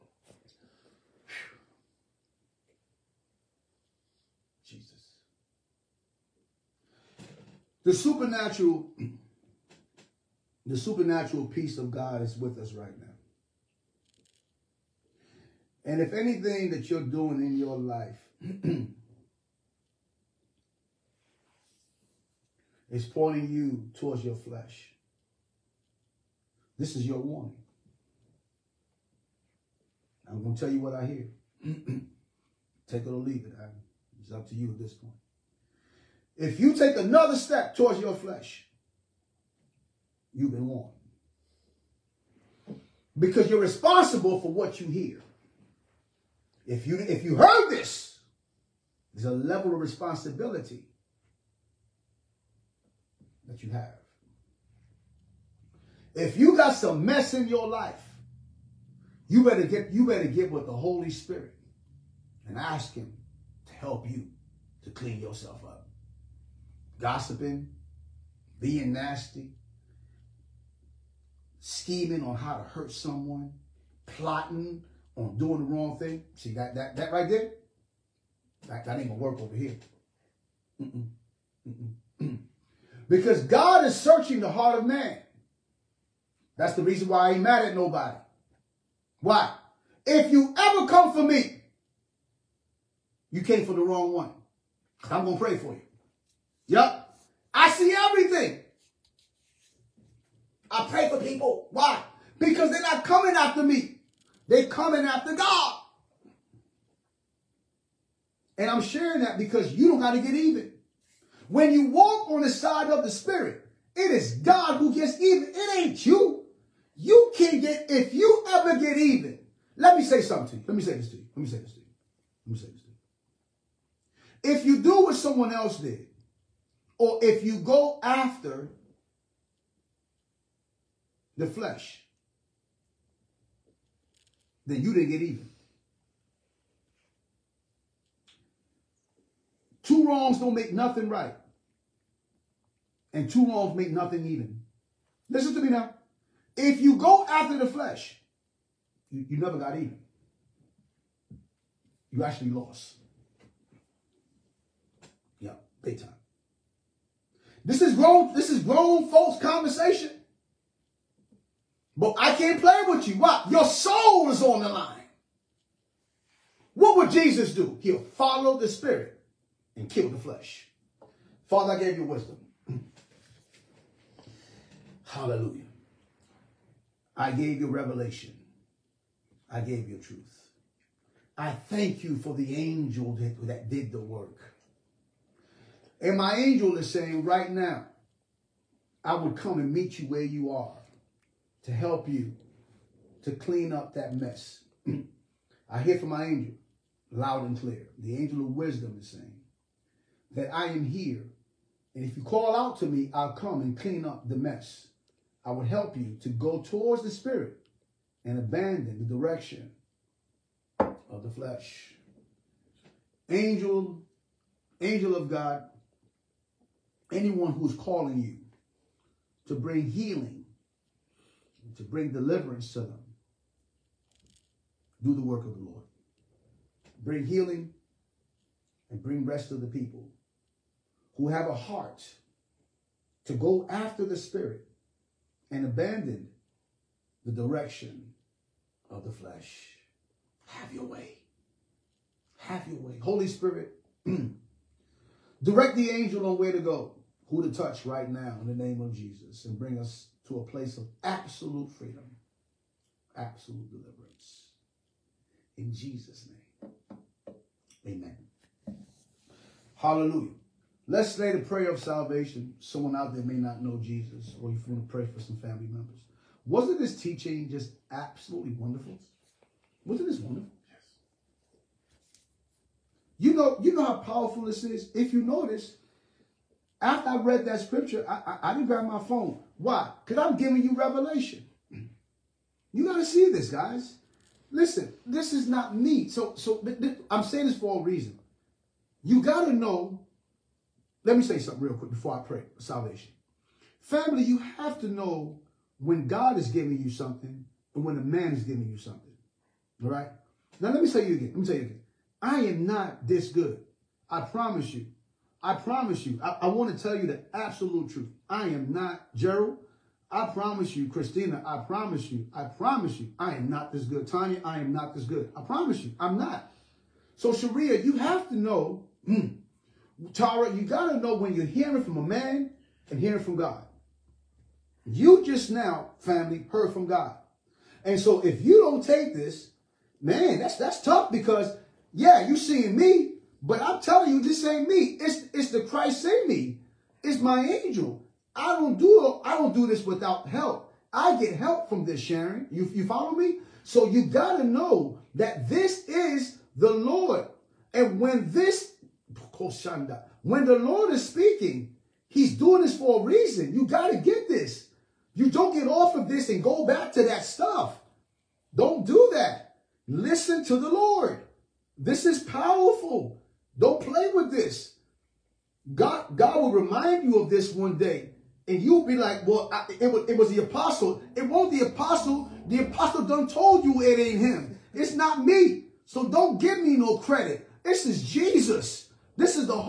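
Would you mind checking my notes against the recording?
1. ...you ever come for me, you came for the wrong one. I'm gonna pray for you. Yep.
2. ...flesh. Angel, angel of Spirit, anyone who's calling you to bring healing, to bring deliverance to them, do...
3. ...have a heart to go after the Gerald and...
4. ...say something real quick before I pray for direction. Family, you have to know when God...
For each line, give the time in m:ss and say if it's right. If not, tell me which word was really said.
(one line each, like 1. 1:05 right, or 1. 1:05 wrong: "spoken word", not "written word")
1. 1:30 right
2. 3:31 wrong: "God", not "Spirit"
3. 3:51 wrong: "Spirit", not "Gerald"
4. 4:51 wrong: "salvation", not "direction".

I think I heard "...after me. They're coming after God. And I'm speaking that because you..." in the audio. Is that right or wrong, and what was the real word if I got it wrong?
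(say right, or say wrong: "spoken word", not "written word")
wrong: "sharing", not "speaking".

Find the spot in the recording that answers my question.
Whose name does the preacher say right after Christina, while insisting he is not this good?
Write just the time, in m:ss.
5:14.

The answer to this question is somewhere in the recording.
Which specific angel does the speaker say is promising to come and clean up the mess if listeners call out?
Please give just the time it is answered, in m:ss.
3:17.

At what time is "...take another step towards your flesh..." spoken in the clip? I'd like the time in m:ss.
0:36.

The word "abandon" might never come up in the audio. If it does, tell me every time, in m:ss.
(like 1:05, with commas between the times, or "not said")
3:28, 3:55.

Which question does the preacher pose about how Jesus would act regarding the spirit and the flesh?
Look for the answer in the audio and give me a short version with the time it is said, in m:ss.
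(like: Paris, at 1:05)
What would Jesus do?, at 2:46.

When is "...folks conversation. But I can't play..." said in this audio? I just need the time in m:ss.
2:39.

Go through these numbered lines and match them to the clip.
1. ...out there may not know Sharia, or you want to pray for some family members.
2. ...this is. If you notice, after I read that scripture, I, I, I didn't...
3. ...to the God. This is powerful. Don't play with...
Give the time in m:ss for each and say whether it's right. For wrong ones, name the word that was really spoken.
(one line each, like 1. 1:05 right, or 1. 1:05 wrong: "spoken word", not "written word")
1. 4:22 wrong: "Jesus", not "Sharia"
2. 4:34 right
3. 6:00 wrong: "Lord", not "God".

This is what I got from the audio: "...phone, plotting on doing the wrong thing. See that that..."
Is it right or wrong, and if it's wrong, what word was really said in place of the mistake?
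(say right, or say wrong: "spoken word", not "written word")
wrong: "someone", not "phone".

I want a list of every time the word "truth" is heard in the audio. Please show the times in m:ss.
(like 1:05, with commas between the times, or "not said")
2:59, 5:07.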